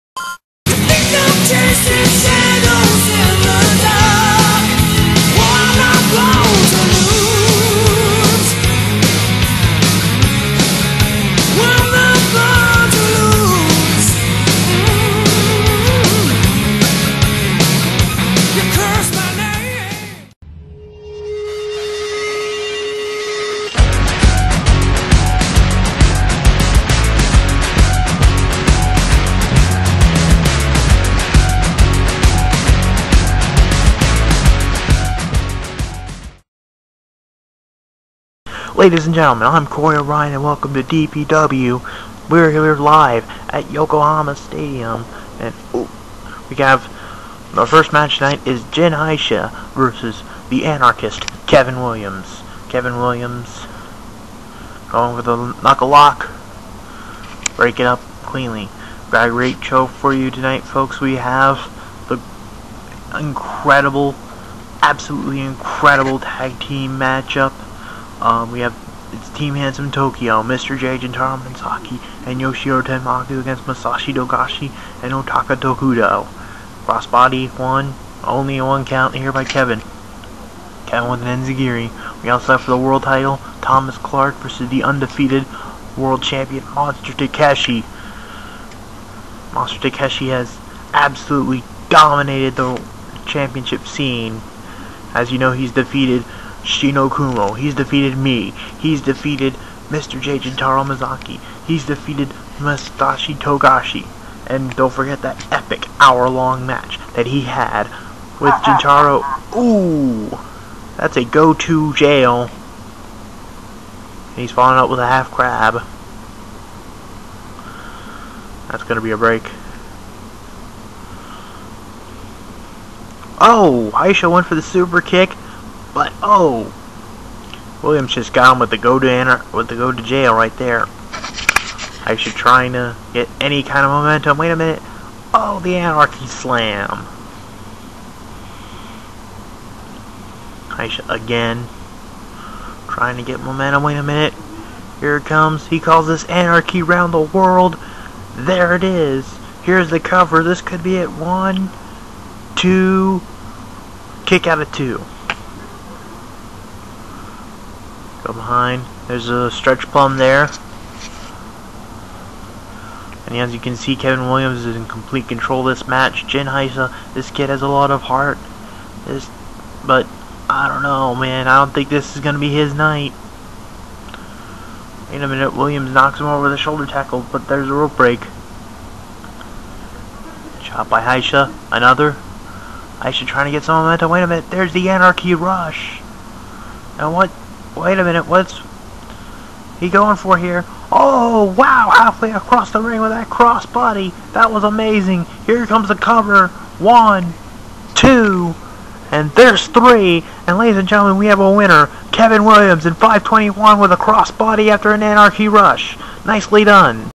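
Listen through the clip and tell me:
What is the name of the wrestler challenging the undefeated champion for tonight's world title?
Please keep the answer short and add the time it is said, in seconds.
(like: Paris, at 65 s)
Thomas Clark, at 83 s.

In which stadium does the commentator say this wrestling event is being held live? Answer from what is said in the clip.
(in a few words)
Yokohama Stadium.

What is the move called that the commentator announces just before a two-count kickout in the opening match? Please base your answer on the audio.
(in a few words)
Anarchy Round the World.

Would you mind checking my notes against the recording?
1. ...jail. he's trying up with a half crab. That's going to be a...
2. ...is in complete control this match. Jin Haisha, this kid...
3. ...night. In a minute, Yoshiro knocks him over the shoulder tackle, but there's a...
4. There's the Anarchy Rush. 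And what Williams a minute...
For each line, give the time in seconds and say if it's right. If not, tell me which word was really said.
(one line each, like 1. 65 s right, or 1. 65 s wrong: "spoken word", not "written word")
1. 111 s wrong: "falling", not "trying"
2. 164 s right
3. 172 s wrong: "Williams", not "Yoshiro"
4. 184 s wrong: "Wait", not "Williams".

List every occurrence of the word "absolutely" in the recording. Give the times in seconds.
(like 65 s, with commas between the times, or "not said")
64 s, 90 s.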